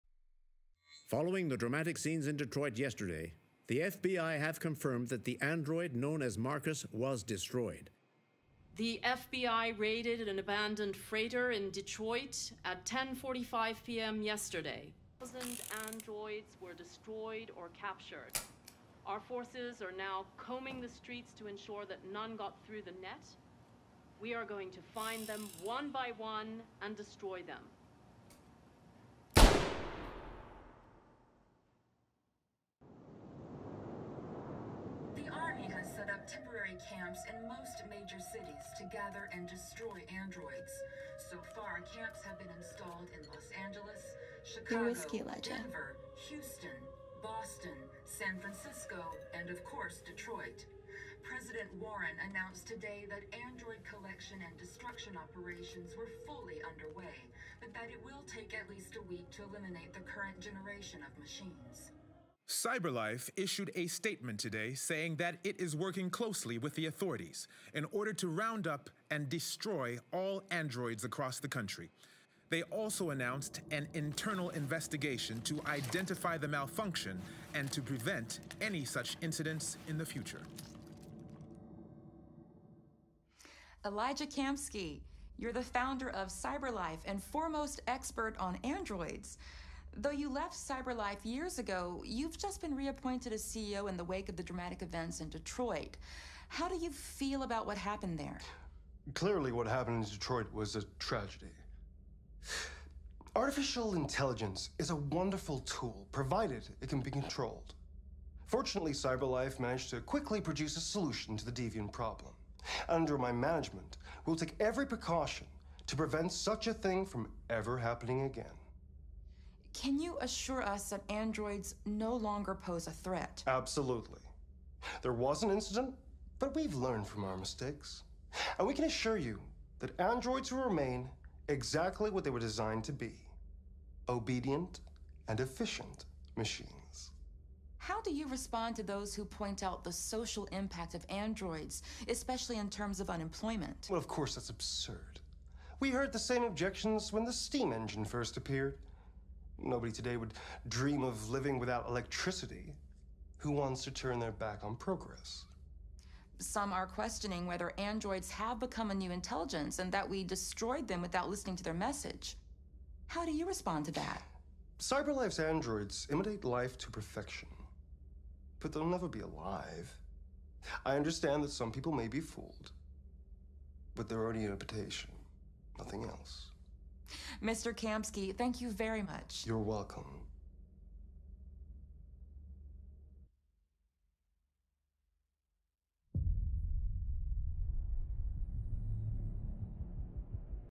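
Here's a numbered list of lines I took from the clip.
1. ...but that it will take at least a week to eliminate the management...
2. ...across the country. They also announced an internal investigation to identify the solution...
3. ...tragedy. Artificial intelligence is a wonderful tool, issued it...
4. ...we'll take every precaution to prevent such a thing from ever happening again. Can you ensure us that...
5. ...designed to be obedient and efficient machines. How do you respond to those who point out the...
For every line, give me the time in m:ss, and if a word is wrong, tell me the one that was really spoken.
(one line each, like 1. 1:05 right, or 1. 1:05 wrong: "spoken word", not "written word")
1. 0:57 wrong: "current", not "management"
2. 1:11 wrong: "malfunction", not "solution"
3. 1:40 wrong: "provided", not "issued"
4. 1:54 wrong: "assure", not "ensure"
5. 2:12 right.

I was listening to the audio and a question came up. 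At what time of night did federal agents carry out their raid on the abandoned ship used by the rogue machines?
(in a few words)
10:45 p.m.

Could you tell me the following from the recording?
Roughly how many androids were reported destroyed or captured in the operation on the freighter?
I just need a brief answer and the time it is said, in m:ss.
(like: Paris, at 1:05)
1000, at 0:15.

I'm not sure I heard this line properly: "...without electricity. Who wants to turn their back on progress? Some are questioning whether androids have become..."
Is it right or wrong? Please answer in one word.
right.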